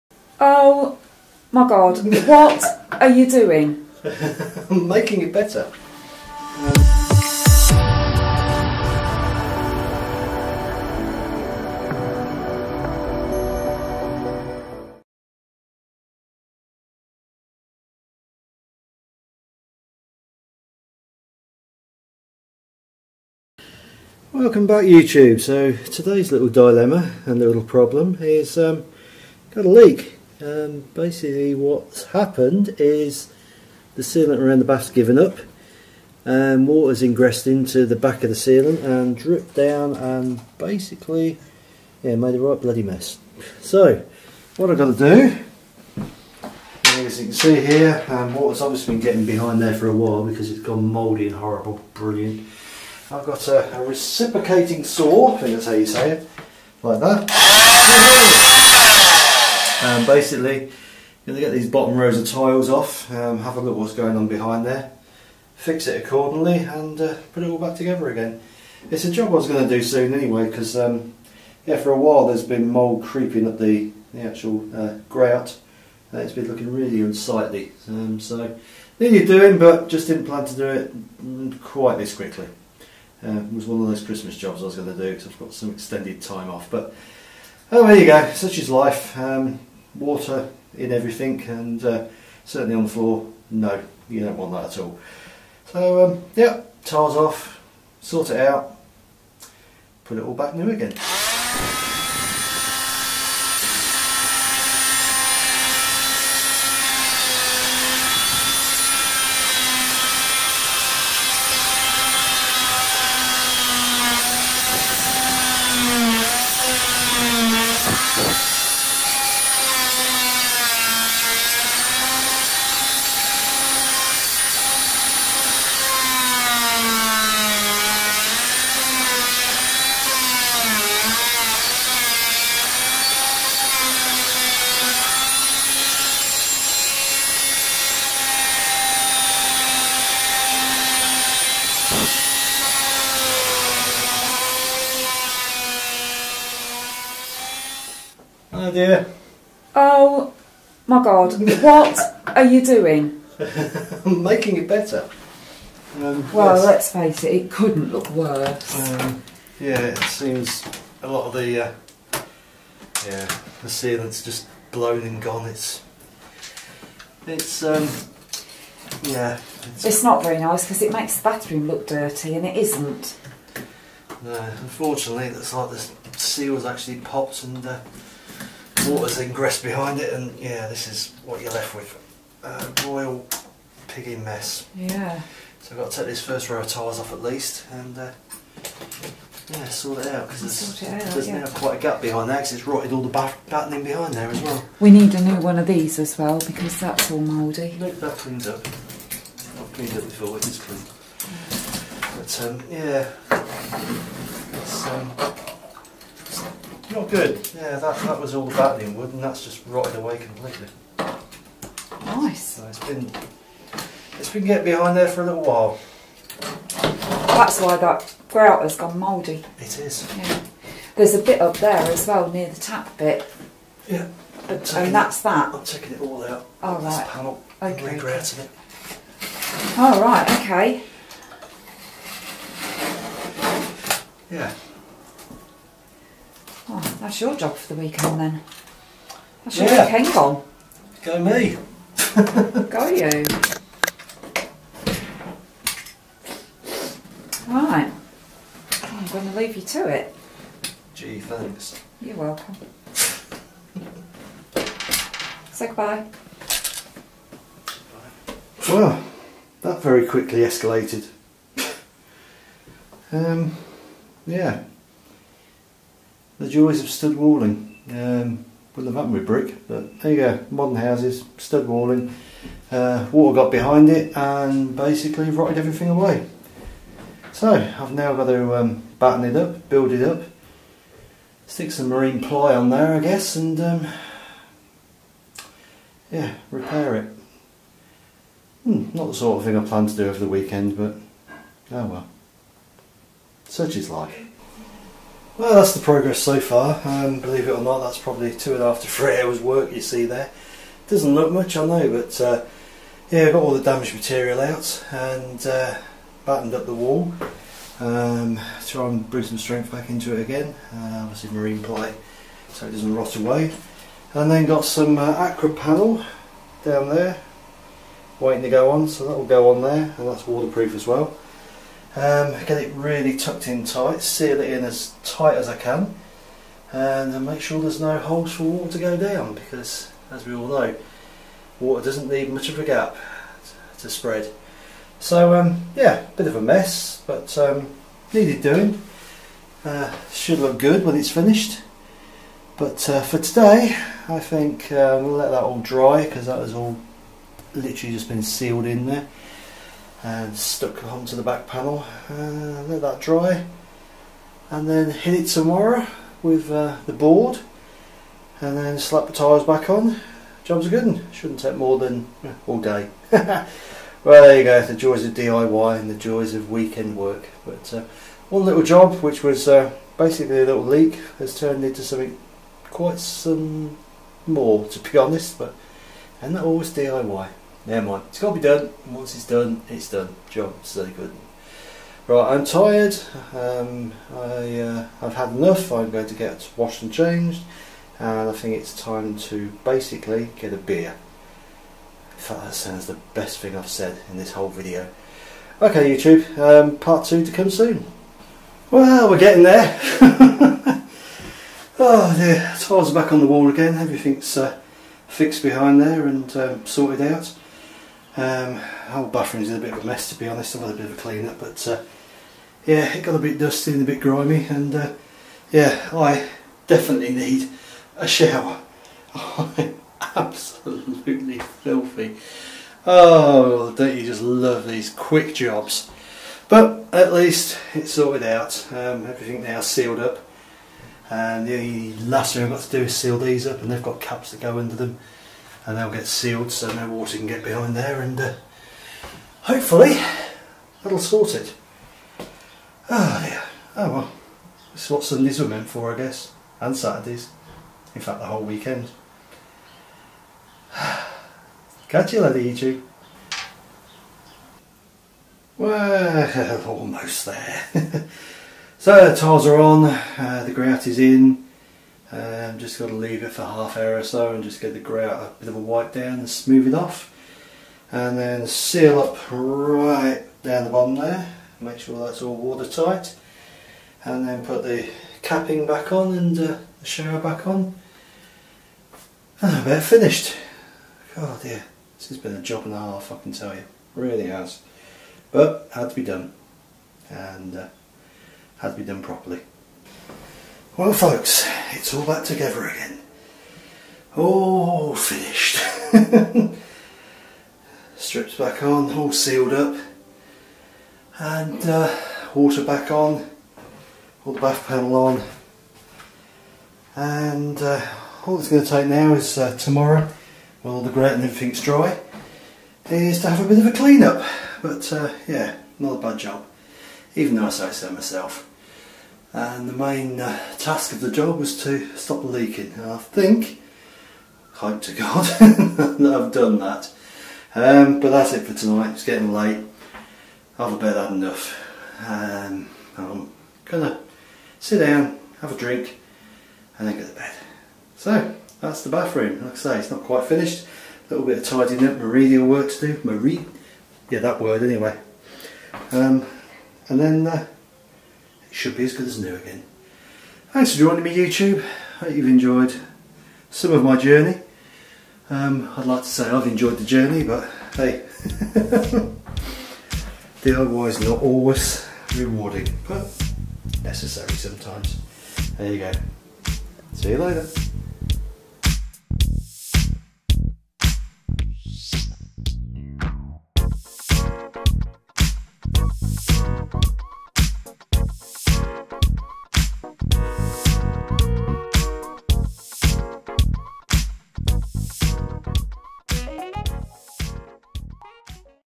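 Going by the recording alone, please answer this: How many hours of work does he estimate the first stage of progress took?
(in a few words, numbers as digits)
2.5 to 3 hours.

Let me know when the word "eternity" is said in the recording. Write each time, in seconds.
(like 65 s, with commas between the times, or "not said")
not said.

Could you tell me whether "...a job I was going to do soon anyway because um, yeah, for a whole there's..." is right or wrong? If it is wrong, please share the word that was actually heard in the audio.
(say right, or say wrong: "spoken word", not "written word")
wrong: "while", not "whole".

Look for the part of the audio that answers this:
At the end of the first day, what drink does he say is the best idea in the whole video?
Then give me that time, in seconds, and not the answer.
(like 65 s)
390 s.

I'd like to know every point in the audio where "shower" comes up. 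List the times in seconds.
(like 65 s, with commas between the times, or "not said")
418 s, 476 s.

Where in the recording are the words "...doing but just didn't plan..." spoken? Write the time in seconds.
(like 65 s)
79 s.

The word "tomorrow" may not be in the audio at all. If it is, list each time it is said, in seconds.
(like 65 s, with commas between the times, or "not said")
355 s, 509 s.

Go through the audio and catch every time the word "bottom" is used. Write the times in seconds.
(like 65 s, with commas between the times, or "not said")
61 s, 470 s.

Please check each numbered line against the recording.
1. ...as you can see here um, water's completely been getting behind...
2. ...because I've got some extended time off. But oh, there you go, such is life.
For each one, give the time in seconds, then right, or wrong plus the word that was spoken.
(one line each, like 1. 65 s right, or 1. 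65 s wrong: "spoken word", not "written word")
1. 46 s wrong: "obviously", not "completely"
2. 85 s right.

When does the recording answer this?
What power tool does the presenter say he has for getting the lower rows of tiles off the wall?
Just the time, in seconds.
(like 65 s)
53 s.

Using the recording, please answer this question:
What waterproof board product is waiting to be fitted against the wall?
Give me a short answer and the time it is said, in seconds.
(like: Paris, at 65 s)
Aqua panel, at 315 s.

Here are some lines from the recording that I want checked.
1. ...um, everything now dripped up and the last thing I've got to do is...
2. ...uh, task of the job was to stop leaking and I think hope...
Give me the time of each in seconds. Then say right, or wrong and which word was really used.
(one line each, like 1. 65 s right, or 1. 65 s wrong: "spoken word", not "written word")
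1. 428 s wrong: "sealed", not "dripped"
2. 520 s right.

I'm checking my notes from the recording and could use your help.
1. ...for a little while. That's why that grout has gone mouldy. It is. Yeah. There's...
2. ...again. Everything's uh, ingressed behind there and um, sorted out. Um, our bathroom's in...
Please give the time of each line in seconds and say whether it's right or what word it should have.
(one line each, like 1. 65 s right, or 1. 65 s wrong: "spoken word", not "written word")
1. 215 s right
2. 403 s wrong: "fixed", not "ingressed".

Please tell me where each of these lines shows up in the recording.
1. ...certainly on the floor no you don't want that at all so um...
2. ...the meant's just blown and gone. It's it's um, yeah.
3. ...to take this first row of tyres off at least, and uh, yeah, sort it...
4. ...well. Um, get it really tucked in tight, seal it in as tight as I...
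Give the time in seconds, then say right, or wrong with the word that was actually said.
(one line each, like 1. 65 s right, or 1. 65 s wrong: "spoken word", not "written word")
1. 92 s right
2. 163 s wrong: "sealant", not "meant"
3. 185 s right
4. 320 s right.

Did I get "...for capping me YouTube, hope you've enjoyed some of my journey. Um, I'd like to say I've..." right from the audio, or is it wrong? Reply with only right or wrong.
wrong.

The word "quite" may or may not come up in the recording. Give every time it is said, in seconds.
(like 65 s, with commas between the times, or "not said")
81 s, 191 s, 372 s, 540 s.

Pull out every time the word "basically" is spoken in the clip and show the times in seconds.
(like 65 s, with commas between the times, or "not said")
30 s, 40 s, 60 s, 274 s, 369 s, 389 s.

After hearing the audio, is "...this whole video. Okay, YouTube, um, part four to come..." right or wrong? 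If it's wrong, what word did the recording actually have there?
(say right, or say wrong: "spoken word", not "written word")
wrong: "two", not "four".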